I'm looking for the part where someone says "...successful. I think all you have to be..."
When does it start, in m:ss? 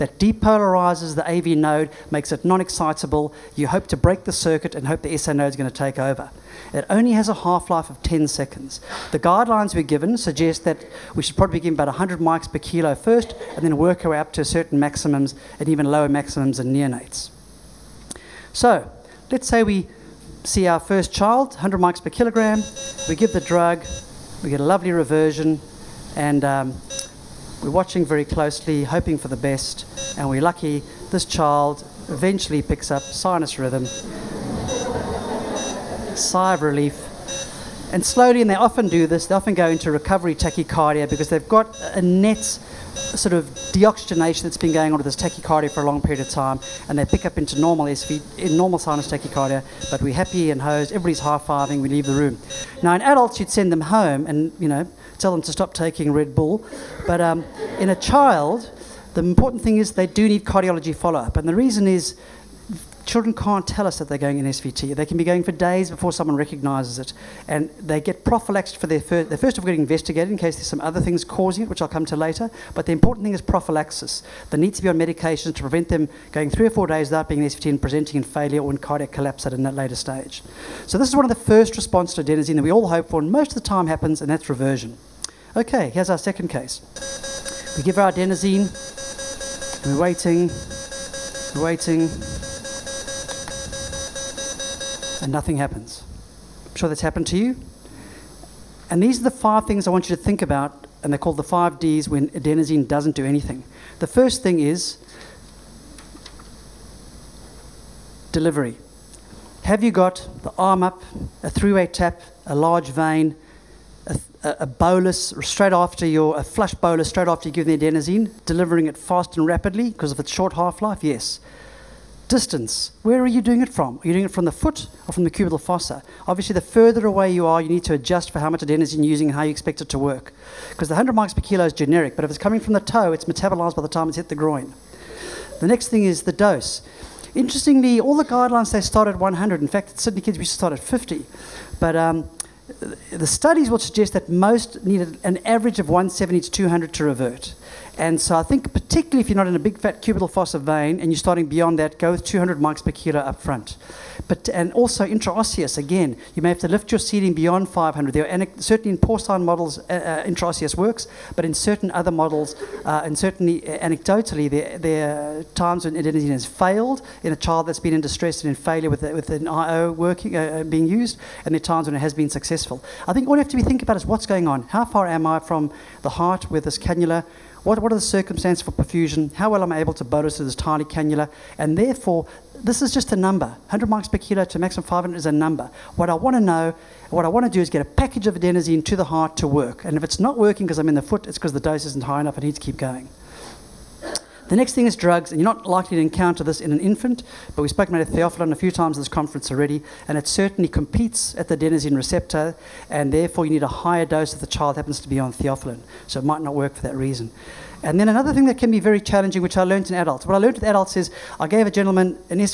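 2:52.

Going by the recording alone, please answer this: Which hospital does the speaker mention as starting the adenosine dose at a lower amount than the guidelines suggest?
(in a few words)
Sydney Kids.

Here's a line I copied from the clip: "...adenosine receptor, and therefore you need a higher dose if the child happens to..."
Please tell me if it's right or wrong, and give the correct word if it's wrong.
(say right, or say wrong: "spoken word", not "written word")
right.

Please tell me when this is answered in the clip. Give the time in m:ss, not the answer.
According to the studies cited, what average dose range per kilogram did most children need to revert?
2:25.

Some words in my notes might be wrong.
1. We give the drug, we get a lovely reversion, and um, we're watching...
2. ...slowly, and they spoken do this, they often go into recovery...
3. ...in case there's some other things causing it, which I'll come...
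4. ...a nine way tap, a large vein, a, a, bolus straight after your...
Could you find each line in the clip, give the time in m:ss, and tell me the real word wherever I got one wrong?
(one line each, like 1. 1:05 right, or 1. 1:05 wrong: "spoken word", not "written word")
1. 0:23 right
2. 0:38 wrong: "often", not "spoken"
3. 1:10 right
4. 1:51 wrong: "three", not "nine".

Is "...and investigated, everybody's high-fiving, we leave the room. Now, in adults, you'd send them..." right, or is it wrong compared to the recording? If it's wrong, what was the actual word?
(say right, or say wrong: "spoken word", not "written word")
wrong: "hosed", not "investigated".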